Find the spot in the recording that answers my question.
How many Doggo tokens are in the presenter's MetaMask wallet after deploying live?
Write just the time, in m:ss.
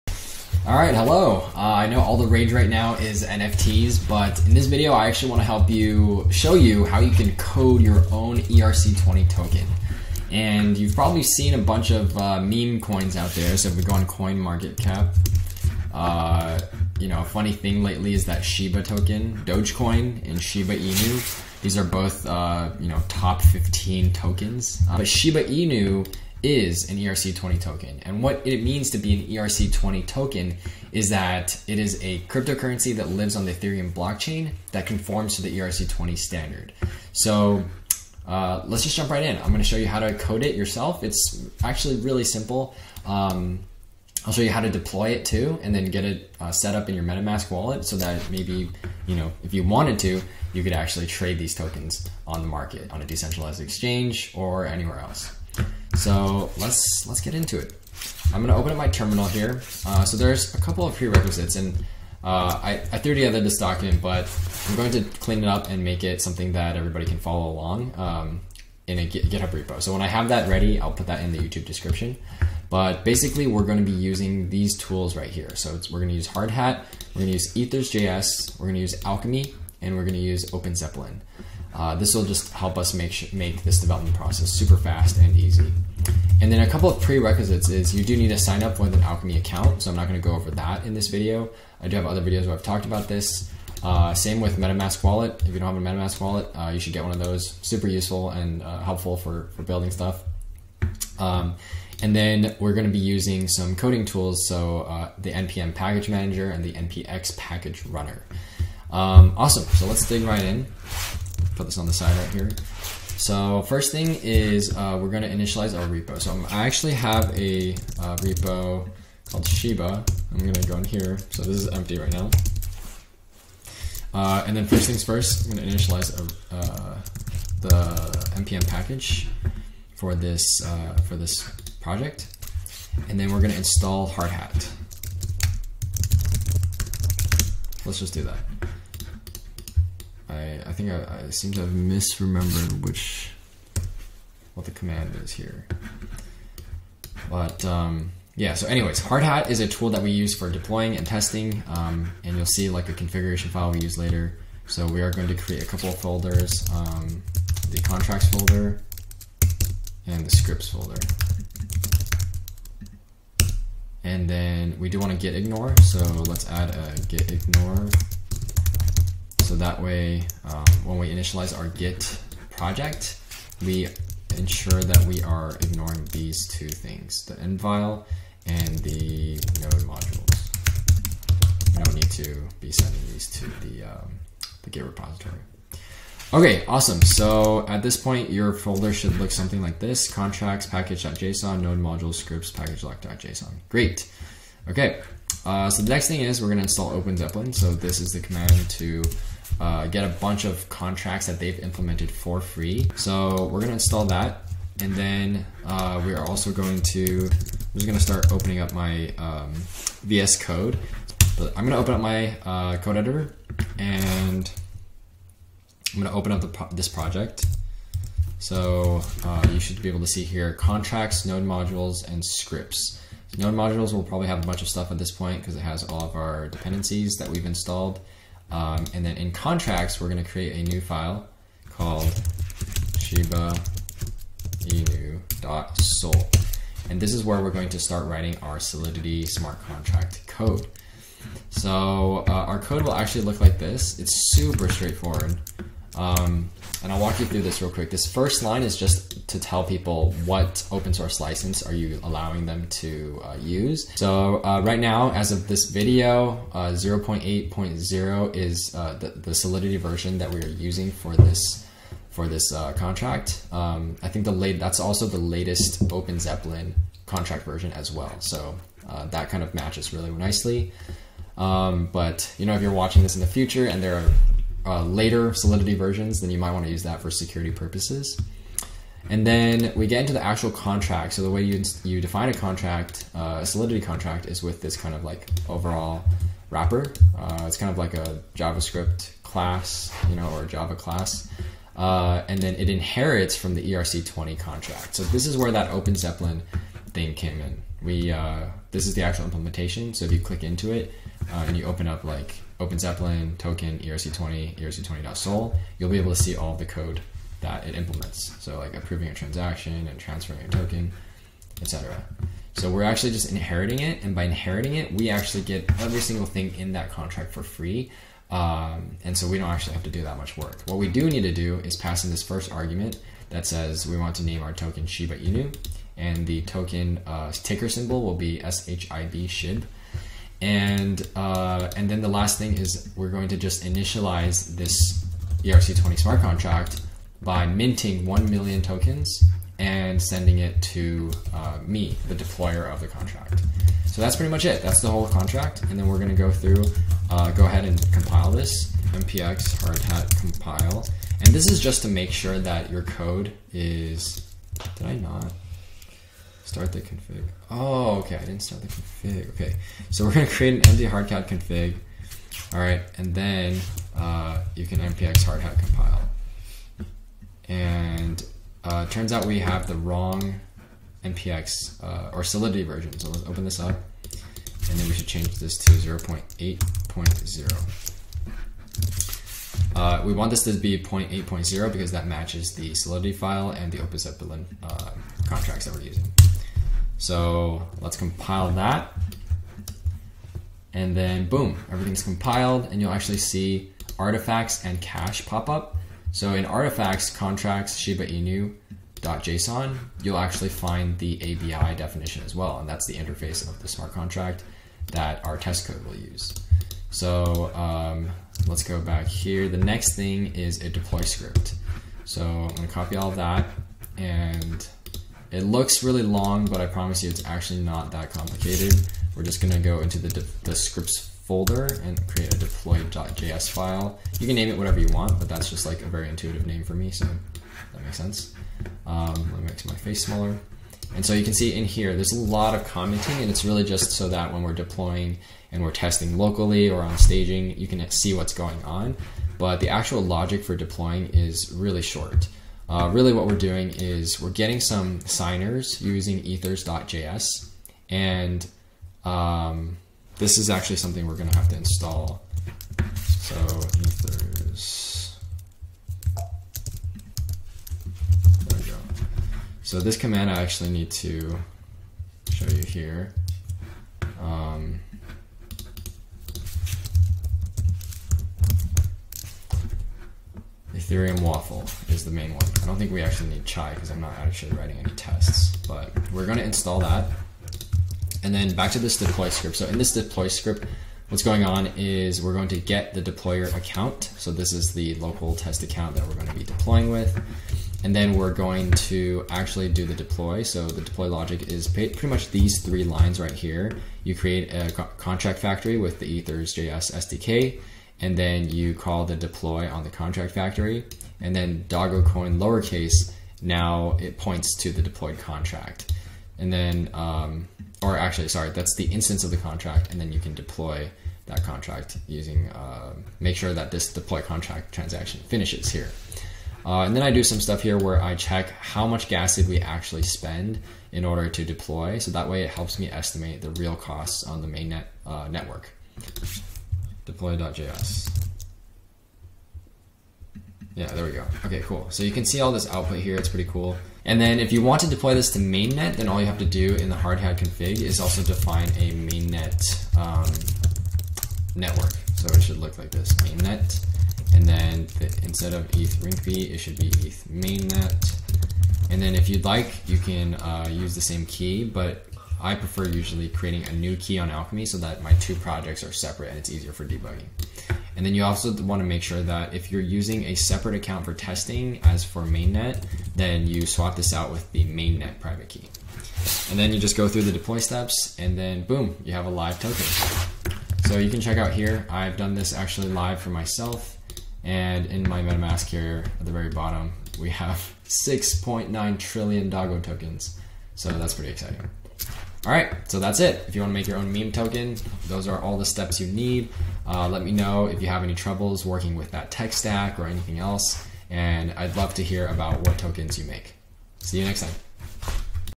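9:37.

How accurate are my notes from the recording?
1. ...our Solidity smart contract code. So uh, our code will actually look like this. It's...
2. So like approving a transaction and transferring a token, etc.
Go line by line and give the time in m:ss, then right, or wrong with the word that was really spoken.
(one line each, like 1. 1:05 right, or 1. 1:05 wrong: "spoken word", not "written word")
1. 3:58 right
2. 5:08 right.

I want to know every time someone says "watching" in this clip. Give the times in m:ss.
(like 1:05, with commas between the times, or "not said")
4:32.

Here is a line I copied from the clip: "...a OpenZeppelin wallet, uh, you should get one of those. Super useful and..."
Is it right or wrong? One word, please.
wrong.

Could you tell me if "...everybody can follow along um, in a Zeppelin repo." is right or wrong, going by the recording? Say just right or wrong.
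wrong.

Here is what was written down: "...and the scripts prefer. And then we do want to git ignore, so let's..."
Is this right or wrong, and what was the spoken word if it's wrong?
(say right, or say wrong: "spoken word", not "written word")
wrong: "folder", not "prefer".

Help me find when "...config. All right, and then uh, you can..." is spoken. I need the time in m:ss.
6:01.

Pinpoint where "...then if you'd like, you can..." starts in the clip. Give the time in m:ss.
9:09.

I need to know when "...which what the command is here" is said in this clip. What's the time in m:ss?
2:22.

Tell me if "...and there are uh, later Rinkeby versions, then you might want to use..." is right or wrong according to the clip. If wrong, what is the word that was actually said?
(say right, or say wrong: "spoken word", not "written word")
wrong: "Solidity", not "Rinkeby".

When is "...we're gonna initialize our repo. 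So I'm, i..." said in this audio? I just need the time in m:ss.
1:54.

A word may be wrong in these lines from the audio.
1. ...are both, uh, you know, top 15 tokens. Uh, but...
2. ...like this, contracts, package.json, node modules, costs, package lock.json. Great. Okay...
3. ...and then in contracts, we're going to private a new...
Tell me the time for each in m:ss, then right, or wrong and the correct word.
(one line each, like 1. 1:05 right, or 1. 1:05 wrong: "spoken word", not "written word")
1. 0:21 right
2. 3:09 wrong: "scripts", not "costs"
3. 3:48 wrong: "create", not "private".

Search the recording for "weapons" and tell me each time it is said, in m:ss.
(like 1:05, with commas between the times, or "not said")
not said.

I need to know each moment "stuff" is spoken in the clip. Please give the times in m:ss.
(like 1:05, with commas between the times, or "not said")
1:39, 3:44, 8:37.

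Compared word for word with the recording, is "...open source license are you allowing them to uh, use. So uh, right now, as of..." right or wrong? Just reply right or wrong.
right.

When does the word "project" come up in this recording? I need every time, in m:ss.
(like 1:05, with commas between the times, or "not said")
2:11, 2:52, 3:36, 9:15.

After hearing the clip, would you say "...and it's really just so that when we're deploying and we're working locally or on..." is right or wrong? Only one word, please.
wrong.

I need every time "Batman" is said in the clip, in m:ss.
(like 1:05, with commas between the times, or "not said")
not said.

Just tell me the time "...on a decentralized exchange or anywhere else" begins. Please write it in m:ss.
0:52.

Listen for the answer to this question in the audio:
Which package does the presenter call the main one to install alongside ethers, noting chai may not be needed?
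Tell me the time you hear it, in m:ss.
7:50.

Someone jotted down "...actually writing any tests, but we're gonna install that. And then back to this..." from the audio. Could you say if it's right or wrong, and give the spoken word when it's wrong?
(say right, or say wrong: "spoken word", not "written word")
right.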